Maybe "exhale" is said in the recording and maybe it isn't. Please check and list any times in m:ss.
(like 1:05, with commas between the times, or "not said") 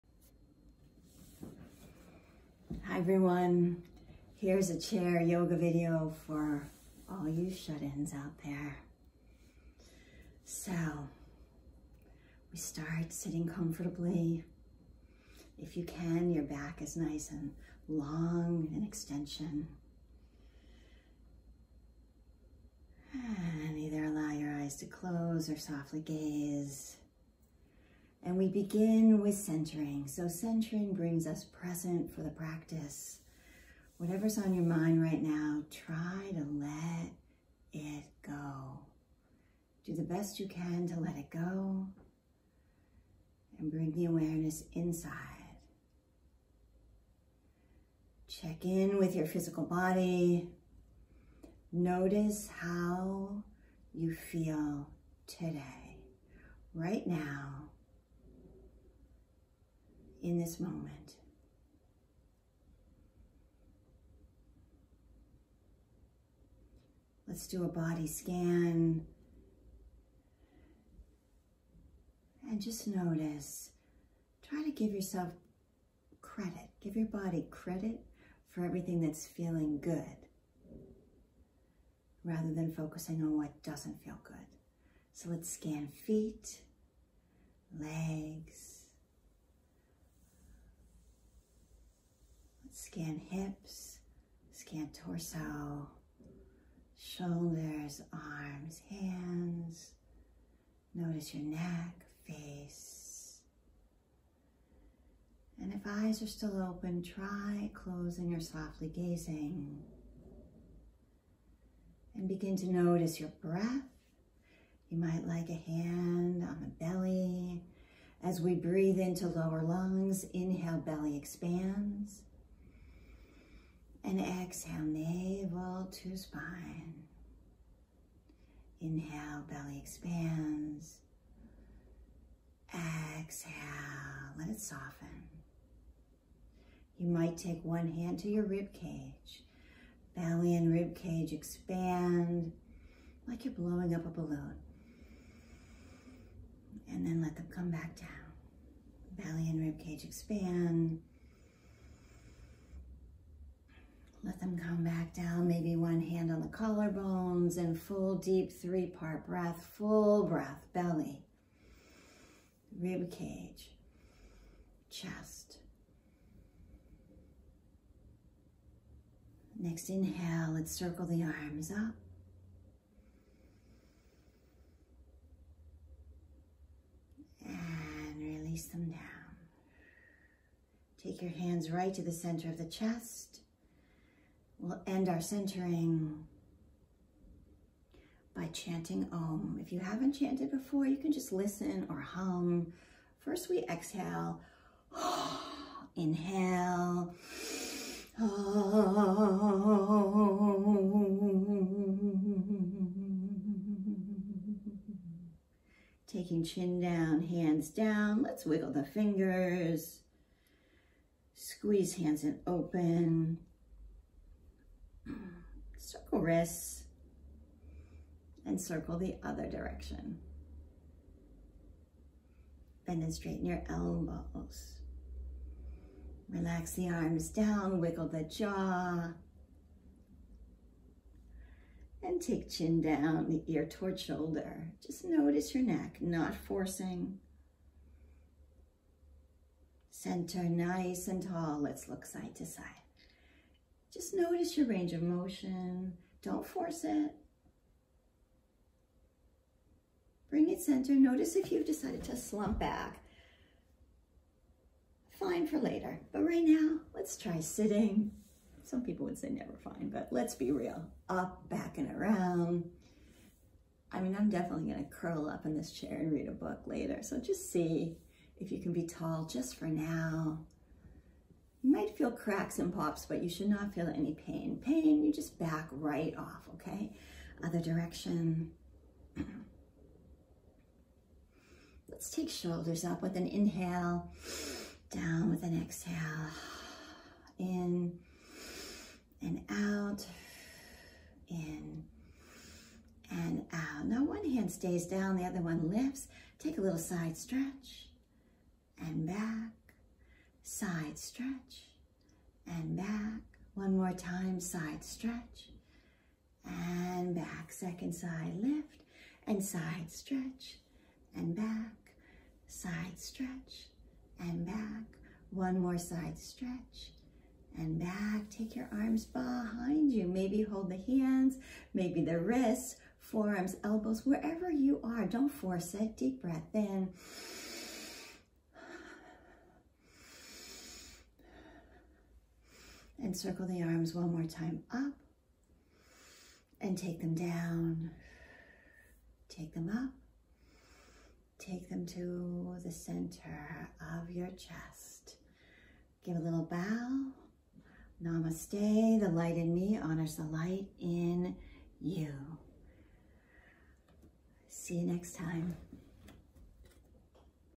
2:04, 2:12, 3:13, 4:45.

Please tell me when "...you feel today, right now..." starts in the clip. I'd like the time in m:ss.
0:53.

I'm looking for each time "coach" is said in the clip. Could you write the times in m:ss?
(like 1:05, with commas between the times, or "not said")
not said.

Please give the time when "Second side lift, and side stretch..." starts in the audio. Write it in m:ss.
5:07.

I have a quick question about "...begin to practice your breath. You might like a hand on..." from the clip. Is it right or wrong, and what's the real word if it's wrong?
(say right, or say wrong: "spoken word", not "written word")
wrong: "notice", not "practice".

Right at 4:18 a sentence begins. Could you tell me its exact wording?
Some people would say never fine, but let's be real.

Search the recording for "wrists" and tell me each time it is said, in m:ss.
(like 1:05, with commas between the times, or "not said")
3:36, 5:22.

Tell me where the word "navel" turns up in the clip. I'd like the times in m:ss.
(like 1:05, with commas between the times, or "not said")
2:04.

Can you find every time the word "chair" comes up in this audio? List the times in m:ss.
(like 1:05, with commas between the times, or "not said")
0:04, 4:25.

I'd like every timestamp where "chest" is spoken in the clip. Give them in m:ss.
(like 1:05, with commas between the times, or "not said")
2:44, 3:02, 5:44.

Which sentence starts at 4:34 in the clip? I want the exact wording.
Pain, you just back right off, okay?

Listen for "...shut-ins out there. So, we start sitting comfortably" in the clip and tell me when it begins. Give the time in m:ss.
0:07.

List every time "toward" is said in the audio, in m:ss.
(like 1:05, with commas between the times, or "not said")
3:53.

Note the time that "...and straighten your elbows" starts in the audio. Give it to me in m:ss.
3:43.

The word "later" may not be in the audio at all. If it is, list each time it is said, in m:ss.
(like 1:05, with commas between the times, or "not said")
4:15, 4:26.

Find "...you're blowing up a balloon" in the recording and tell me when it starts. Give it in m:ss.
2:23.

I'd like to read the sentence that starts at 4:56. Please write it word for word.
Take a little side stretch and back side stretch, and back.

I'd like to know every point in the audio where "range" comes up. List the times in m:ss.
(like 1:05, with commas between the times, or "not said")
4:04.